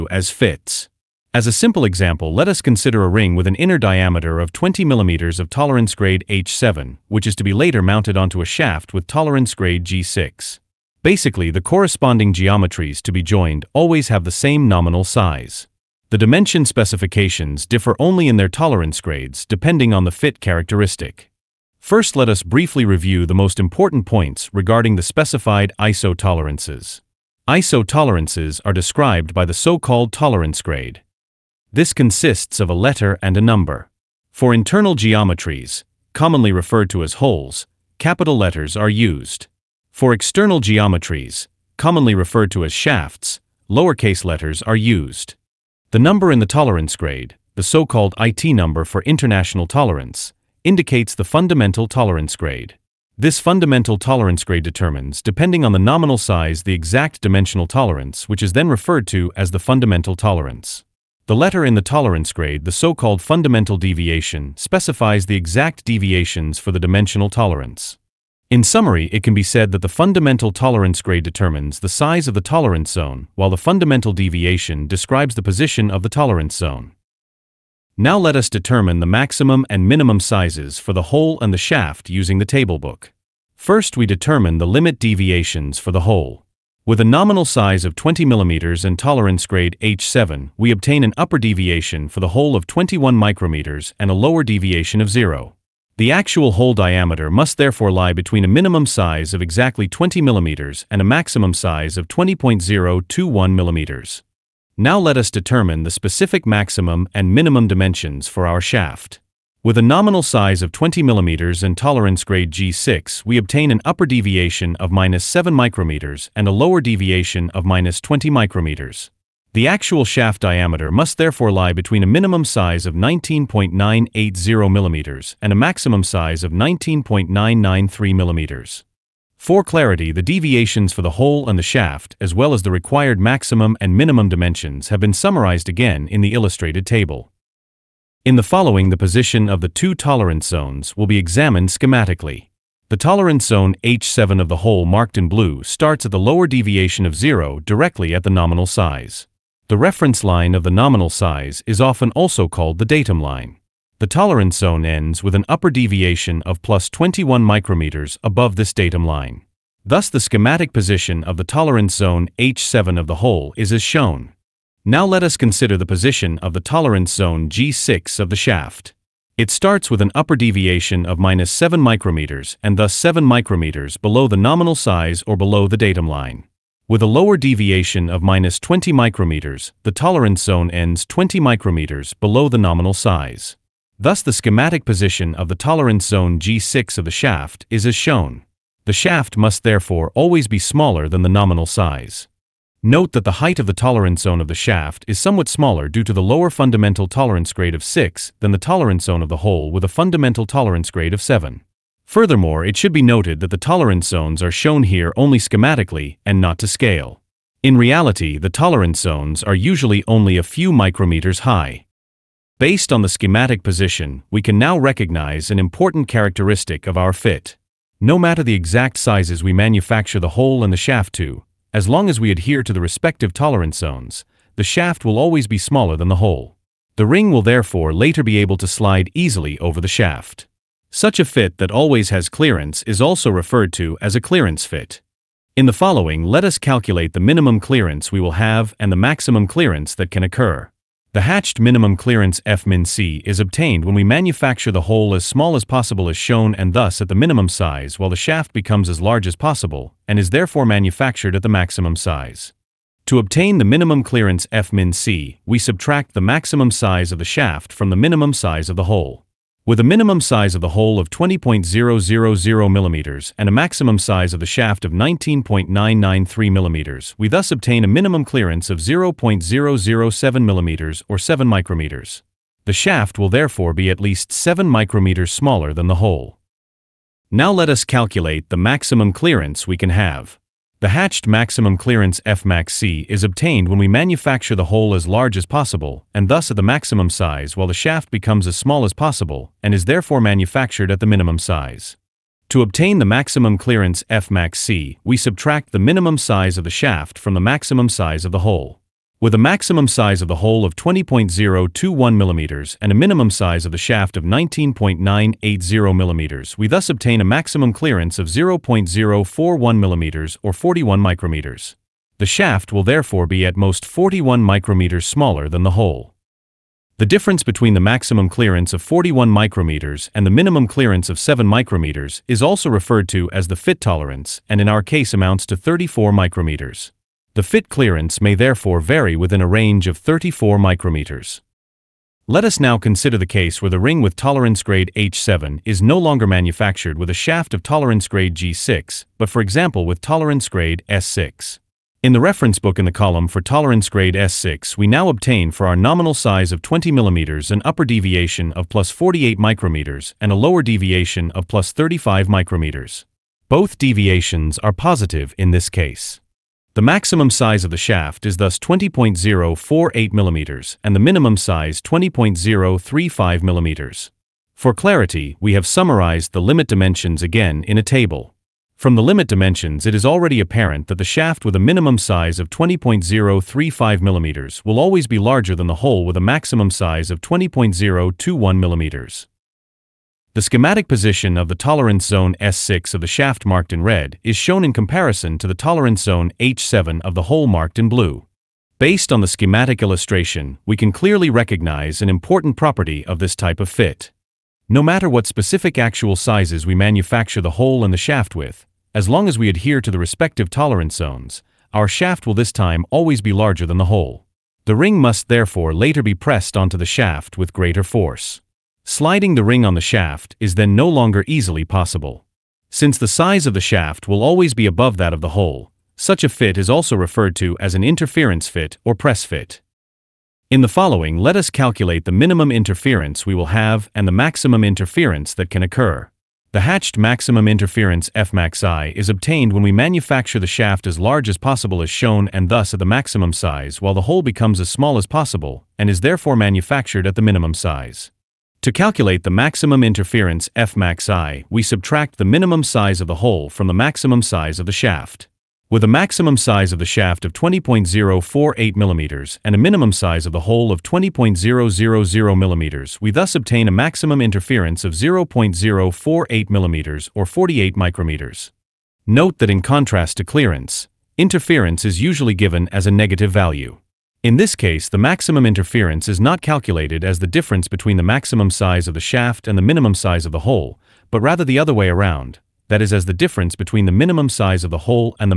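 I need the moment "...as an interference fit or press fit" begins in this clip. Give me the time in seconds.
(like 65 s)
417 s.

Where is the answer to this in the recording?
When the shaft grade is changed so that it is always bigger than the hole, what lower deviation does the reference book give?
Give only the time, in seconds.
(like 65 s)
351 s.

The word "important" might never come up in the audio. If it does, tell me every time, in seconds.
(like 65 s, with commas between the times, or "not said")
23 s, 215 s, 392 s.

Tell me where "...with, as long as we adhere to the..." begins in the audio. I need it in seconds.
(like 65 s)
398 s.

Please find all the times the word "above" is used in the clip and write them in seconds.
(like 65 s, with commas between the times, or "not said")
158 s, 414 s.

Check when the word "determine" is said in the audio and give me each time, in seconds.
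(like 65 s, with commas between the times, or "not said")
54 s, 71 s, 78 s, 84 s, 105 s.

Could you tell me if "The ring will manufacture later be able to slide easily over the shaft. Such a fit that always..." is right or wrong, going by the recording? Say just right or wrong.
wrong.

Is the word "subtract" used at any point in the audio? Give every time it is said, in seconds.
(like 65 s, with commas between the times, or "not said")
255 s, 295 s, 441 s.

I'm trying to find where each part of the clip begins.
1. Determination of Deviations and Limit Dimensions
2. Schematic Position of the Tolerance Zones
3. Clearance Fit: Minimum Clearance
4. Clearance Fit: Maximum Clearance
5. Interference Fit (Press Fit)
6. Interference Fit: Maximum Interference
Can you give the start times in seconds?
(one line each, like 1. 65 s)
1. 73 s
2. 137 s
3. 211 s
4. 276 s
5. 331 s
6. 419 s.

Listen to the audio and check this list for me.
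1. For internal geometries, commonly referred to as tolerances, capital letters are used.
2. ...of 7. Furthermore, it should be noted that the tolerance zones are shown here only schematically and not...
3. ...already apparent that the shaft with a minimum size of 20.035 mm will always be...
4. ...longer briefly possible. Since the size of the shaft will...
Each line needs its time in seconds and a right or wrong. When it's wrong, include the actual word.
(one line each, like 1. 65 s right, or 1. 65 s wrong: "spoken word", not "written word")
1. 34 s wrong: "holes", not "tolerances"
2. 201 s right
3. 370 s right
4. 410 s wrong: "easily", not "briefly".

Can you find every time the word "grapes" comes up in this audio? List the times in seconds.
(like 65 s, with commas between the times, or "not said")
not said.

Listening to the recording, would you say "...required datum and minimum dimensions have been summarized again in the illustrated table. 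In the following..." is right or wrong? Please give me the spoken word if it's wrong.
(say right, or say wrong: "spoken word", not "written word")
wrong: "maximum", not "datum".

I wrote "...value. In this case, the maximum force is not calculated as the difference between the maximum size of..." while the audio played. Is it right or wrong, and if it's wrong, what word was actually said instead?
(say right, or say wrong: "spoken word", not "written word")
wrong: "interference", not "force".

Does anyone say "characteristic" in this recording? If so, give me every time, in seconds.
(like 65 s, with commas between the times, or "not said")
20 s, 216 s.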